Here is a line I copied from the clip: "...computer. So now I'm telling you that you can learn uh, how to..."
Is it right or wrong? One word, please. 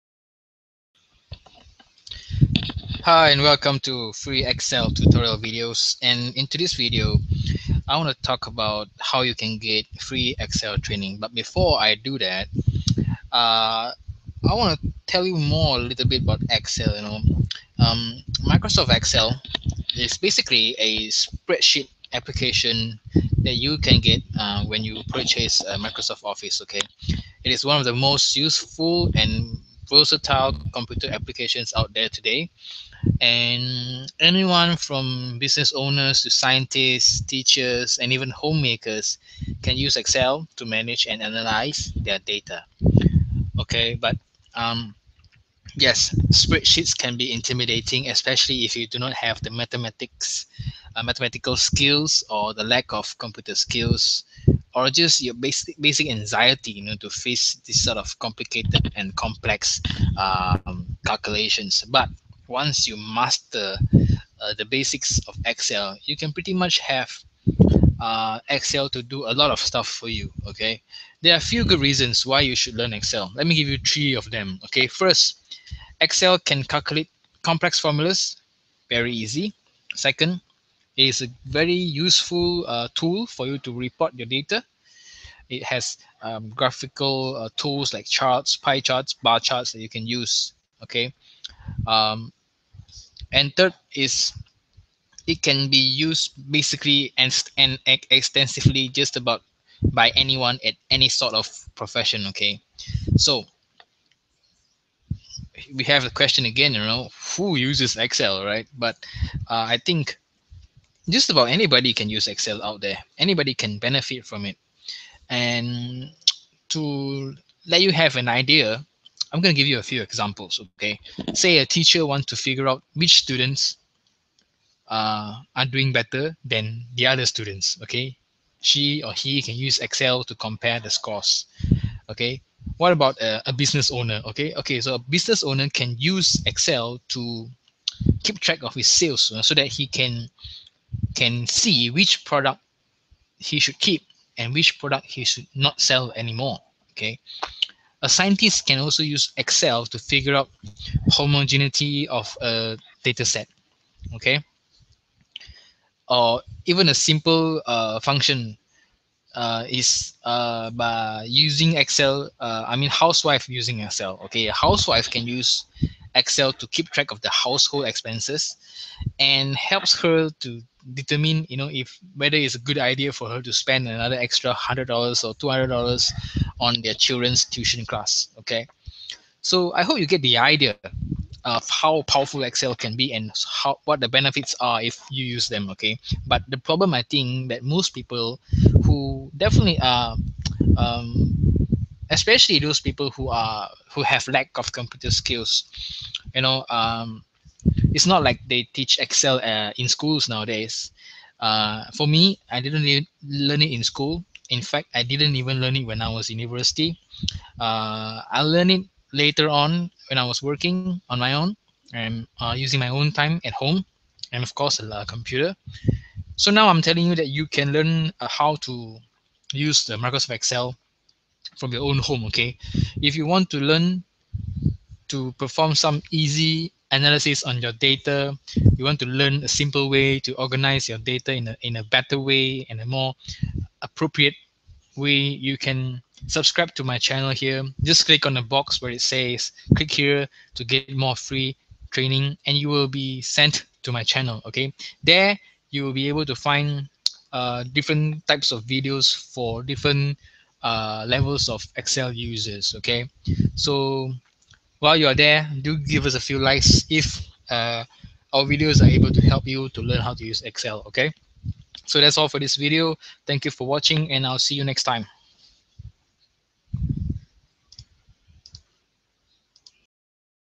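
right.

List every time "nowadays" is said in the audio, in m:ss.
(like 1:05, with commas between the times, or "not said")
3:20.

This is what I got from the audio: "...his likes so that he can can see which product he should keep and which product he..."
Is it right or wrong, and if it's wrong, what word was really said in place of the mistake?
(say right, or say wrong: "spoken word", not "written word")
wrong: "sales", not "likes".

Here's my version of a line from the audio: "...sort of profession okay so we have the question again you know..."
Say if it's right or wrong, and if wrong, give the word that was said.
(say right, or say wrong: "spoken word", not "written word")
right.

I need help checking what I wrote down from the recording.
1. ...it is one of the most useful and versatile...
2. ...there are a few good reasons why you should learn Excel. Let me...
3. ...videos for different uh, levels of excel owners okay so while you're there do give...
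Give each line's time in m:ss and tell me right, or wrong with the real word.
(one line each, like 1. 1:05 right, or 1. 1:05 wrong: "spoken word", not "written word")
1. 0:27 right
2. 1:11 right
3. 4:08 wrong: "users", not "owners".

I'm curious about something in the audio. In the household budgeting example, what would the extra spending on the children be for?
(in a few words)
Tuition class.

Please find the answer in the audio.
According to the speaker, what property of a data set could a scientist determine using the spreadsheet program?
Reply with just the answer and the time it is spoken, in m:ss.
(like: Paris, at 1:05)
Homogeneity, at 2:31.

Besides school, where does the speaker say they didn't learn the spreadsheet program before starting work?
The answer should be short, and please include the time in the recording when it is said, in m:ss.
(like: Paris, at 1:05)
University, at 3:26.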